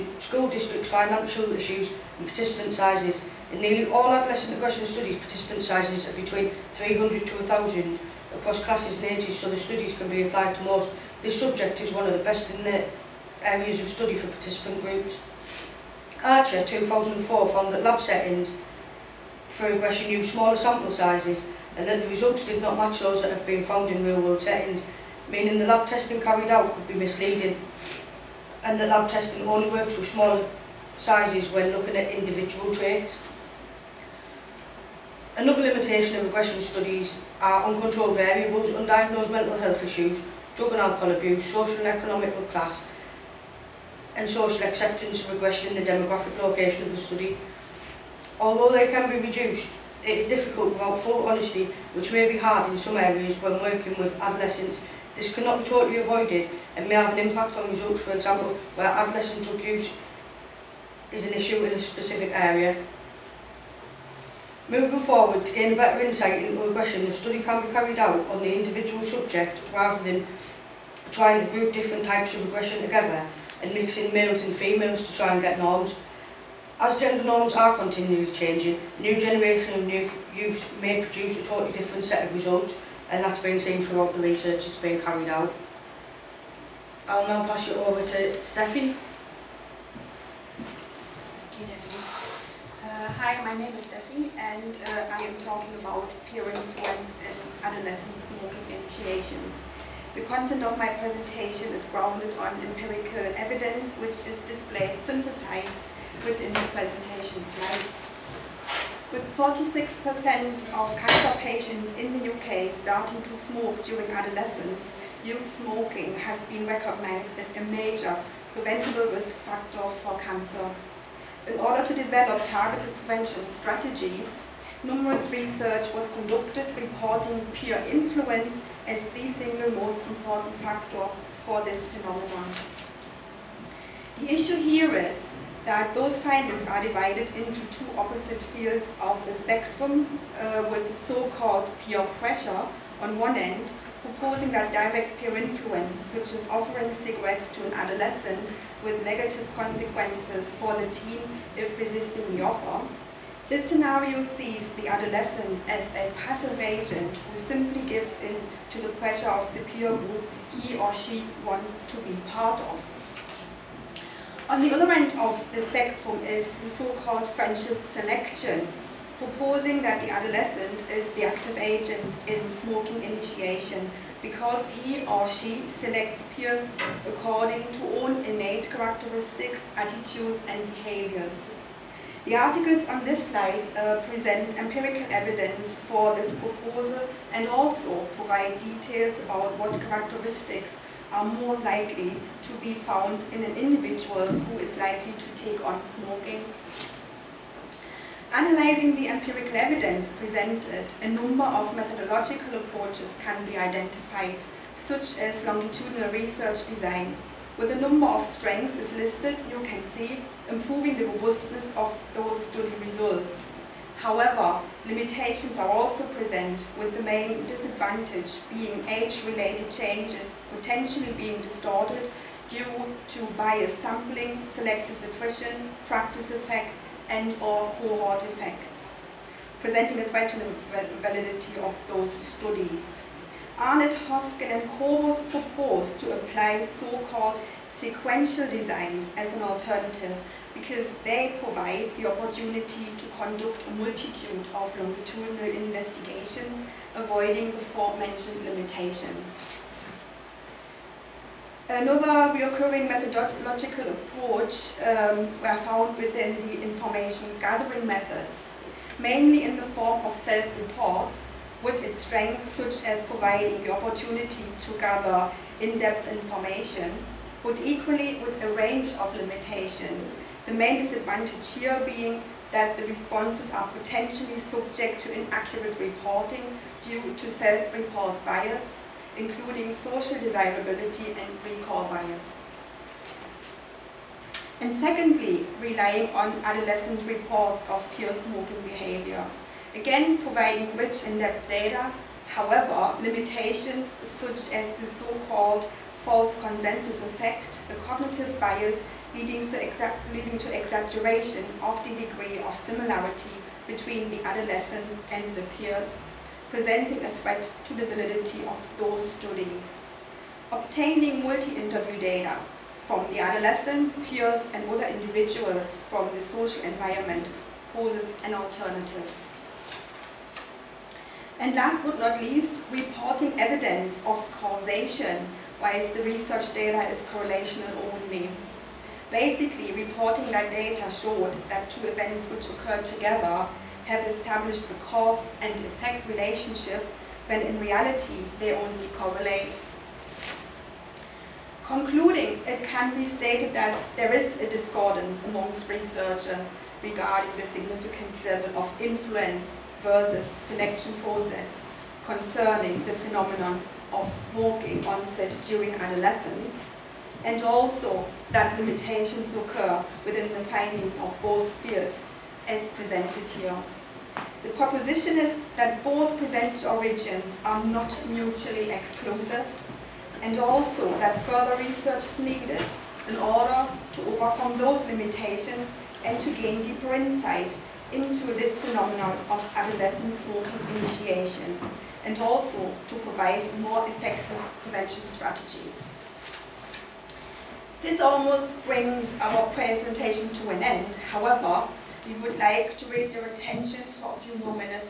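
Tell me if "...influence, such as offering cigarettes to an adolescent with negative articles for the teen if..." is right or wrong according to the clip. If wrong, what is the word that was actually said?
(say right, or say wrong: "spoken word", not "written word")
wrong: "consequences", not "articles".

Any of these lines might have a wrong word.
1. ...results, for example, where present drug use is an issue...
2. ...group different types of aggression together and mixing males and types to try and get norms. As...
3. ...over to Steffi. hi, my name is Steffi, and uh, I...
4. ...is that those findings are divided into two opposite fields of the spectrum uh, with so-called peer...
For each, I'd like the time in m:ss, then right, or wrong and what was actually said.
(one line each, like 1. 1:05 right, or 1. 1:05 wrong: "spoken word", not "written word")
1. 0:57 wrong: "adolescent", not "present"
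2. 1:11 wrong: "females", not "types"
3. 1:27 right
4. 2:14 right.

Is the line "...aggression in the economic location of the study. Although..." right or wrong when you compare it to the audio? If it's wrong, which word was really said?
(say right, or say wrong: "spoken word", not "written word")
wrong: "demographic", not "economic".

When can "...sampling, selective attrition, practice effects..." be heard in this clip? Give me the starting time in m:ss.
3:43.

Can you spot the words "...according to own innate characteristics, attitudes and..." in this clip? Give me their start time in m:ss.
2:57.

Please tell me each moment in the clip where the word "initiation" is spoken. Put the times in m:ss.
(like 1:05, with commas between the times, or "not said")
1:38, 2:53, 6:20.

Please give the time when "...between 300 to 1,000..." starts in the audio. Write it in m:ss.
0:06.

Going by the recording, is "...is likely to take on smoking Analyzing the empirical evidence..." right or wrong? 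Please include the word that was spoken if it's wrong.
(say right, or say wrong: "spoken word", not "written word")
right.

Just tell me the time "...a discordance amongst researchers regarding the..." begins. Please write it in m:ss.
5:44.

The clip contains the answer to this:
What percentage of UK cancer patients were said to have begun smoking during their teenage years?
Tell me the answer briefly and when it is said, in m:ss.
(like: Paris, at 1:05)
46%, at 1:49.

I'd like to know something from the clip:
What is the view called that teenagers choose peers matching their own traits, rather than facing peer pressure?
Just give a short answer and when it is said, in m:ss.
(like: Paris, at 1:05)
friendship selection, at 2:47.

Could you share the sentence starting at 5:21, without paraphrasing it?
And last but not least, reporting evidence of causation, whilst the research data is correlational only.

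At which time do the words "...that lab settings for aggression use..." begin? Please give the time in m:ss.
0:17.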